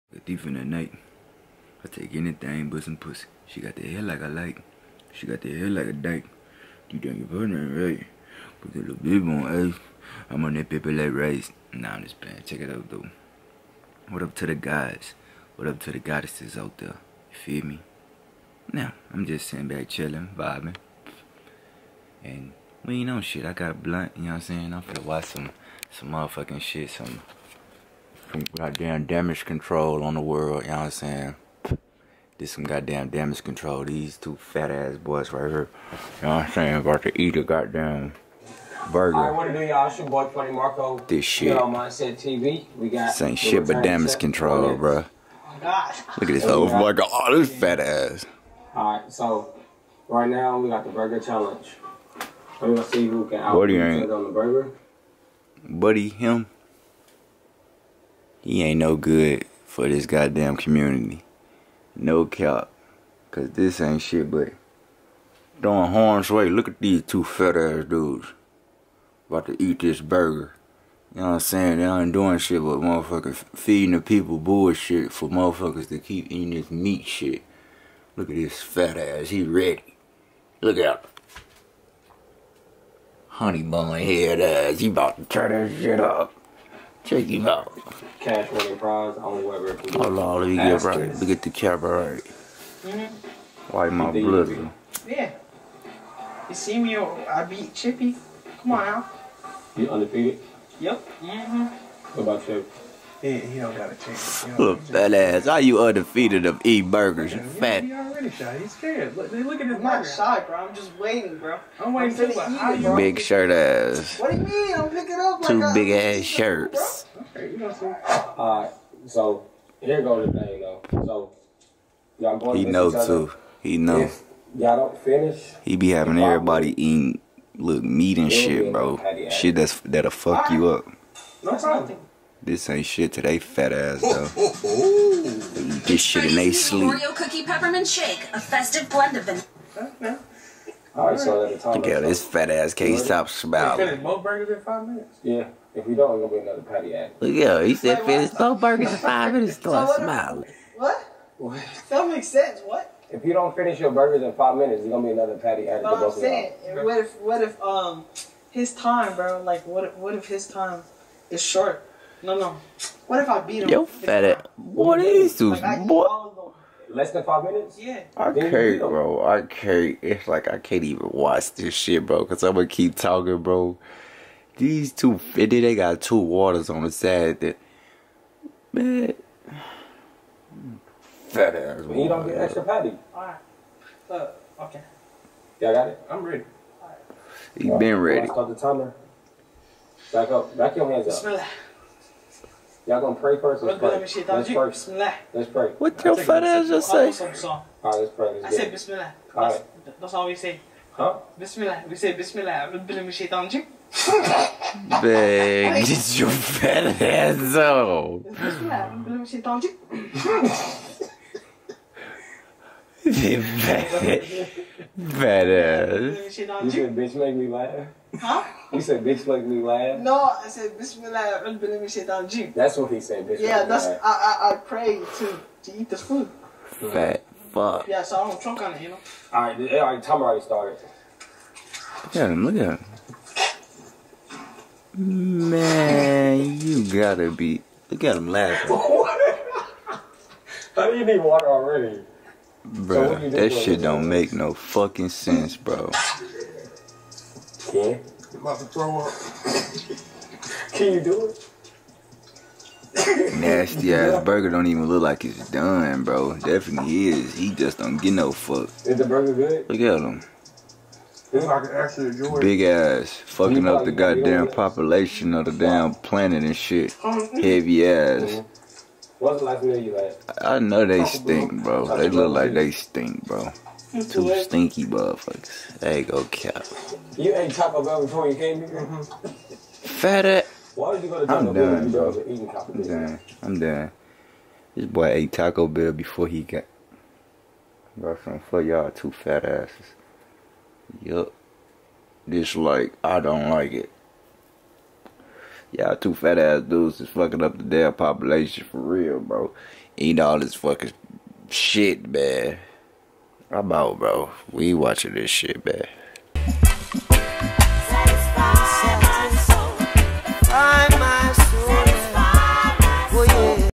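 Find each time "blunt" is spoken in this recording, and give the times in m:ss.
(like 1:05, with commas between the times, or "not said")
0:23.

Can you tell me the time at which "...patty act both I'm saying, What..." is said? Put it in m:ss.
2:35.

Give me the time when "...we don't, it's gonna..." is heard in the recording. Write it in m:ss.
2:25.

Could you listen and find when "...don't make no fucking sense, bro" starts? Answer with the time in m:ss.
4:03.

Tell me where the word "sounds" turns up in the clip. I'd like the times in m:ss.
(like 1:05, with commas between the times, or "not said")
not said.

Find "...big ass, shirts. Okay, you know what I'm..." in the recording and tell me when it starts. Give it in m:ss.
1:55.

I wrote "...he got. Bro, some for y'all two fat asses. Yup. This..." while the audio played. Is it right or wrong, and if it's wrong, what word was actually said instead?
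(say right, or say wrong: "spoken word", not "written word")
right.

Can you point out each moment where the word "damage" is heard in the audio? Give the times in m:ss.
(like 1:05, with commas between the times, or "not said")
0:29, 0:33, 0:43.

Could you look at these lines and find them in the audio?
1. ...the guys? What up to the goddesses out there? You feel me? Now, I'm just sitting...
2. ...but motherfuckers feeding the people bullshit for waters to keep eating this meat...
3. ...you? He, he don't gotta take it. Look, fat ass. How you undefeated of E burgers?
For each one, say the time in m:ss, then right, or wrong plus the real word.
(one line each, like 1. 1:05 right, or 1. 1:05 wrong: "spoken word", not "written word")
1. 0:14 right
2. 1:12 wrong: "motherfuckers", not "waters"
3. 1:42 right.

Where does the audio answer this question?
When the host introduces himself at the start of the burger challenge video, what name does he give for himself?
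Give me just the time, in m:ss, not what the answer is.
0:40.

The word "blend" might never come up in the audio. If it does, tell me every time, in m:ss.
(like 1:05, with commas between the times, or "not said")
2:18.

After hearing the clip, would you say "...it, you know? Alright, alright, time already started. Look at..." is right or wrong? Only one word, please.
right.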